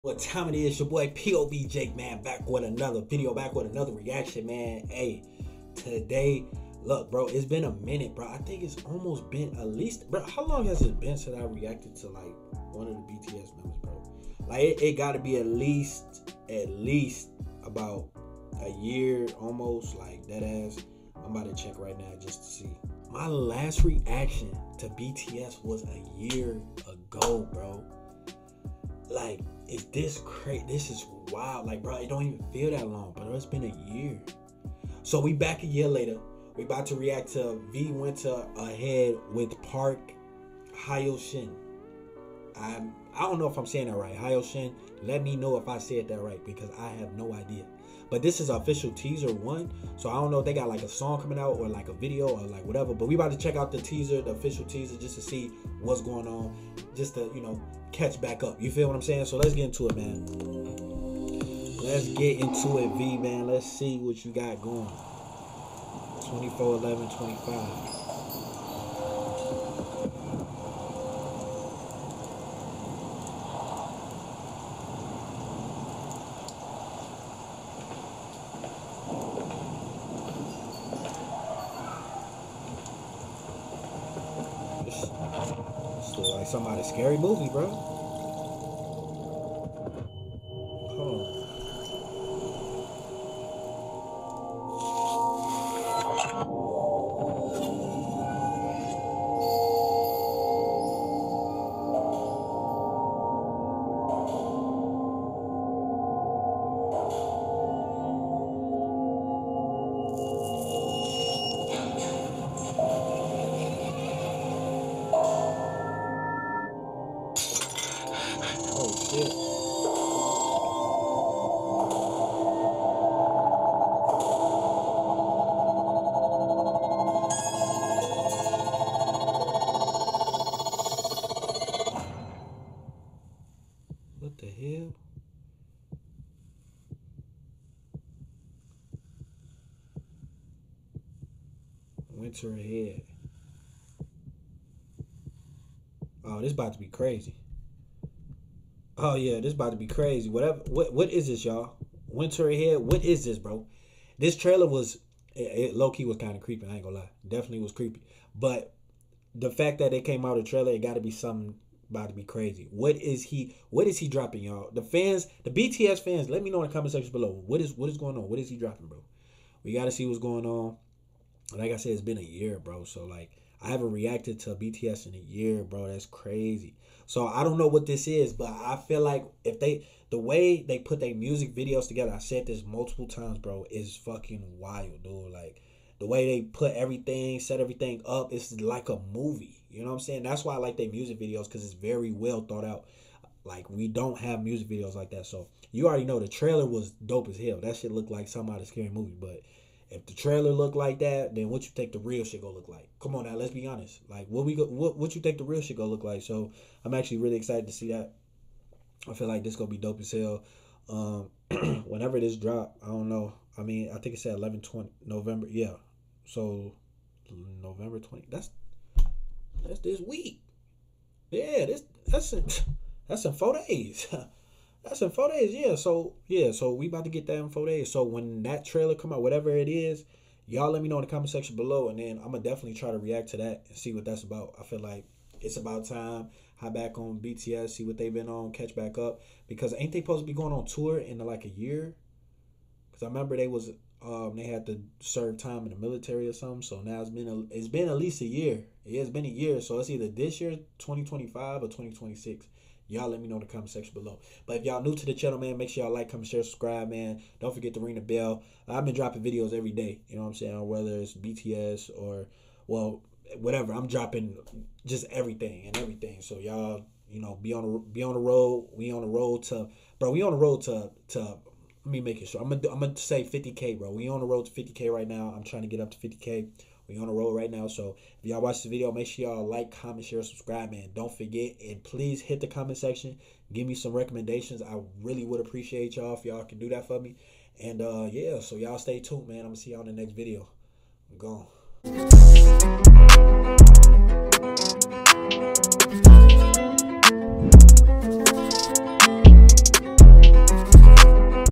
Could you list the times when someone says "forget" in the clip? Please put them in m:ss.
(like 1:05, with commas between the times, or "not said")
4:17, 4:41.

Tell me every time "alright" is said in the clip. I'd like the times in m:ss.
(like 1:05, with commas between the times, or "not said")
not said.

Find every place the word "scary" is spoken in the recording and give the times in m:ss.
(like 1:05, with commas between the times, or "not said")
1:26, 3:18.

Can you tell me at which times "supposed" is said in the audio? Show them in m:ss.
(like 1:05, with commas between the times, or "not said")
4:00.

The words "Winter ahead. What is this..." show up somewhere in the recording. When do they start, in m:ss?
2:32.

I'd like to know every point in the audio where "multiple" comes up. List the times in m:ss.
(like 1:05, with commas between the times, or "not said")
3:02.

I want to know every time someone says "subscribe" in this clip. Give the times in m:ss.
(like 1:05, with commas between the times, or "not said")
4:16, 4:40.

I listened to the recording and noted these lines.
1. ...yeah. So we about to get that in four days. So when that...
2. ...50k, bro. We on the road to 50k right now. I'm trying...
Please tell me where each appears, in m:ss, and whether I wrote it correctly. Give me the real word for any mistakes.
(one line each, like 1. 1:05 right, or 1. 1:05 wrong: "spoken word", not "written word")
1. 3:46 right
2. 4:33 right.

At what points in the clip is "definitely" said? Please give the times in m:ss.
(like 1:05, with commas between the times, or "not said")
2:37, 3:52.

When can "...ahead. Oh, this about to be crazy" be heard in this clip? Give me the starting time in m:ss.
2:22.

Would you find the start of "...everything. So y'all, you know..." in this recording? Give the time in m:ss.
4:25.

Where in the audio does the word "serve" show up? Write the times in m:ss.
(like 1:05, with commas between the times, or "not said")
4:04.